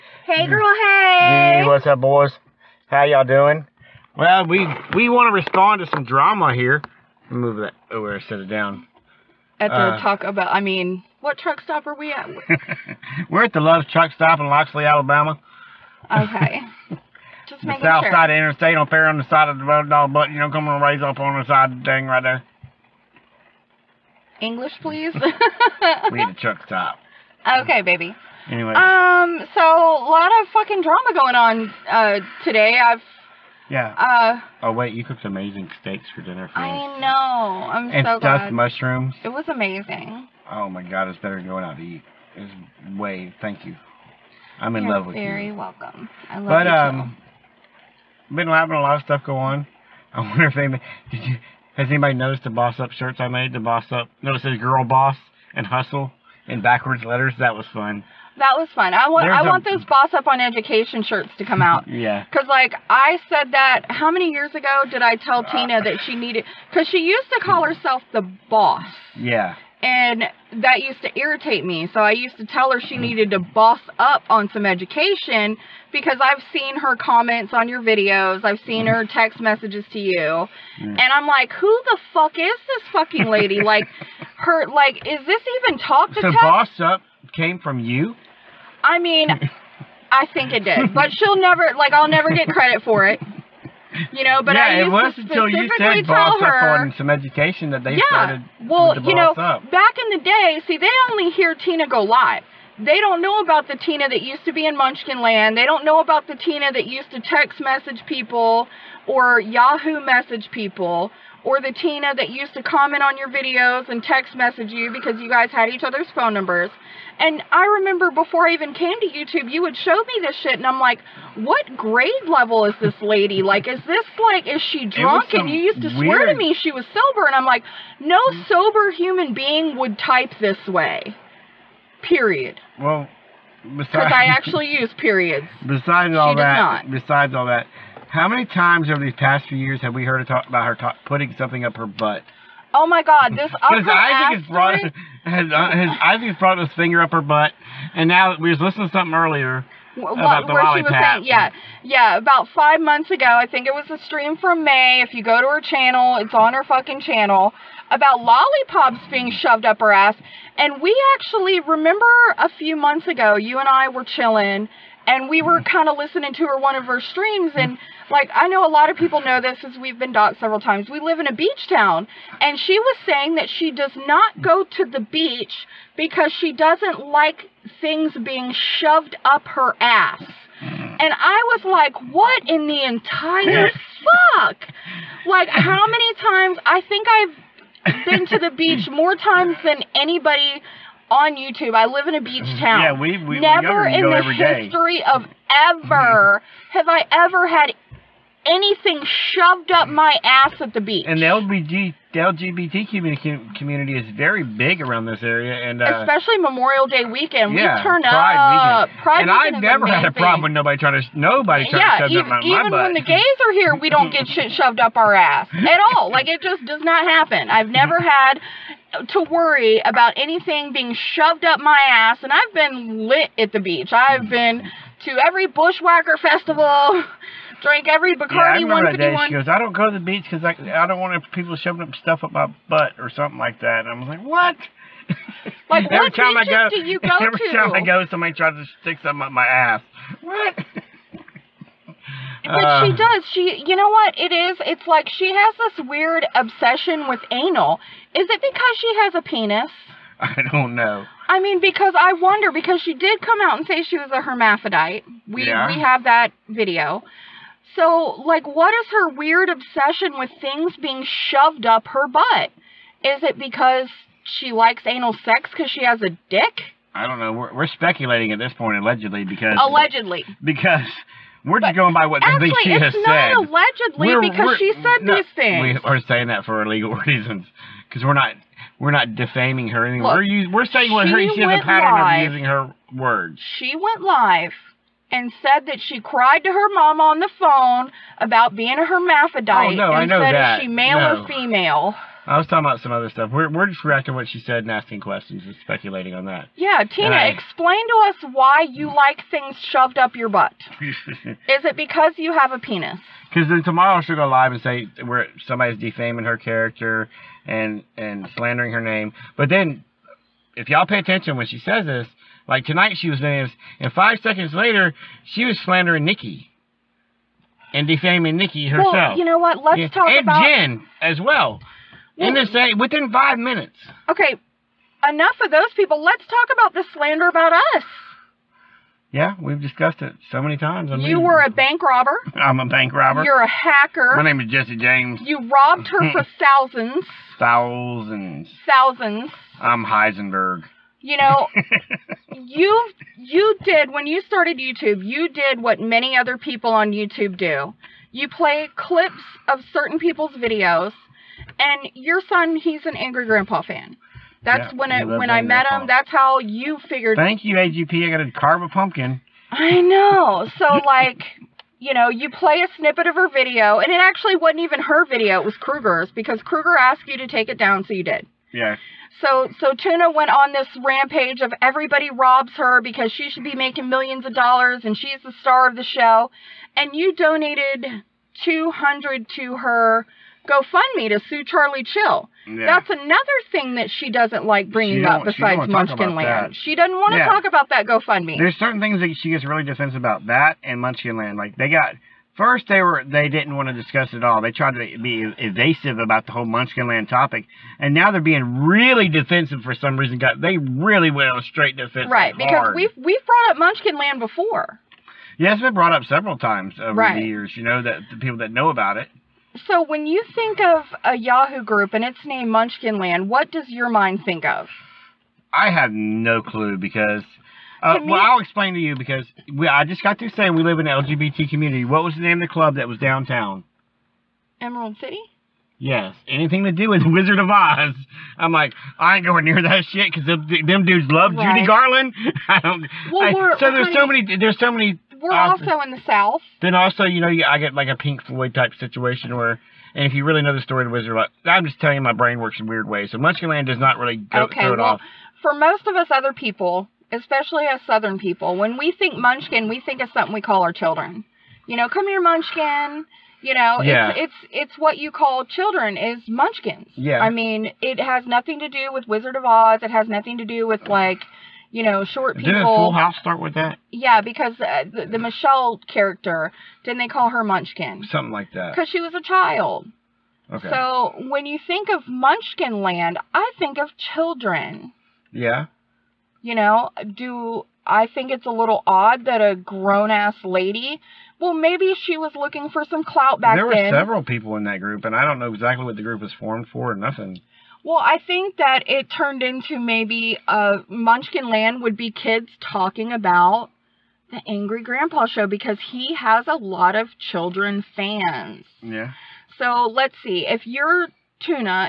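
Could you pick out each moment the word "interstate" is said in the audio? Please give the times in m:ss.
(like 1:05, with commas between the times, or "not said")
0:18.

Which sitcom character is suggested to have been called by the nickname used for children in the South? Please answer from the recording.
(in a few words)
Michelle.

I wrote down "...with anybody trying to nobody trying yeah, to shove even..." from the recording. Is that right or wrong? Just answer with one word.
wrong.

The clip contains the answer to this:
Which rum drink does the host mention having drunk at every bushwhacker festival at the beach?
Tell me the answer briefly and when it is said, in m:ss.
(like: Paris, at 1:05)
Bacardi 151, at 3:48.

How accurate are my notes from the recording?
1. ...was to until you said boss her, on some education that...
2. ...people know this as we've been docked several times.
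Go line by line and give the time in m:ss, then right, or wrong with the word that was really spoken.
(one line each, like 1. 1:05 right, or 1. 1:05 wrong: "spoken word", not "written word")
1. 1:34 right
2. 2:48 right.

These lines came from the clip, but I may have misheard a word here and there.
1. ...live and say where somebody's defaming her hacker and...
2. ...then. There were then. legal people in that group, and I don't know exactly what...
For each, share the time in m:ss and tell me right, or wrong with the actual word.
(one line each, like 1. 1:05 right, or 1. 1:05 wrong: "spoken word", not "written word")
1. 5:04 wrong: "character", not "hacker"
2. 8:03 wrong: "several", not "legal".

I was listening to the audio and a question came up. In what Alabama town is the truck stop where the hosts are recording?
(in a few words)
Loxley.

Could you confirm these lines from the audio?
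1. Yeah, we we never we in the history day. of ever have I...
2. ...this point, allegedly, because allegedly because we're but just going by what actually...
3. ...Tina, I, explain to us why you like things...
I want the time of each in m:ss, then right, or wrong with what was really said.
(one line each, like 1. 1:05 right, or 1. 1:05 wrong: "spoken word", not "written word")
1. 3:12 right
2. 4:28 right
3. 4:56 right.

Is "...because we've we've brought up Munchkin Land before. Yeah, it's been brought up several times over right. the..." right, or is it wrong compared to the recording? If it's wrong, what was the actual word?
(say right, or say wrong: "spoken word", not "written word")
right.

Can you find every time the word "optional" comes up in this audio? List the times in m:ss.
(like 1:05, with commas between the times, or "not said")
not said.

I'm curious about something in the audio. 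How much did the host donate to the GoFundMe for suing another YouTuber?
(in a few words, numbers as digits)
200.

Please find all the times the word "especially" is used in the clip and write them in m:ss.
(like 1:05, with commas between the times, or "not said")
3:26, 7:27.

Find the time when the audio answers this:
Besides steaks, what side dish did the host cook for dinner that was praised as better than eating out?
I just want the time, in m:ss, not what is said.
0:38.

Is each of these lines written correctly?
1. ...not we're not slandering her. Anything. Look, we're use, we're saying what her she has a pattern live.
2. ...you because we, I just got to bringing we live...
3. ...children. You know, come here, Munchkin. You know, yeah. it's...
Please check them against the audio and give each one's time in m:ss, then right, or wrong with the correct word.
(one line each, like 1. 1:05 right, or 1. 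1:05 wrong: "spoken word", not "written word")
1. 4:38 wrong: "defaming", not "slandering"
2. 6:58 wrong: "saying", not "bringing"
3. 7:30 right.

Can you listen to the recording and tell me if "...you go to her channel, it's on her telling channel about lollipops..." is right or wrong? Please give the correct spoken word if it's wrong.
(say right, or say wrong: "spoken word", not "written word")
wrong: "fucking", not "telling".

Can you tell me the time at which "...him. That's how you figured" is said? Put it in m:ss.
5:55.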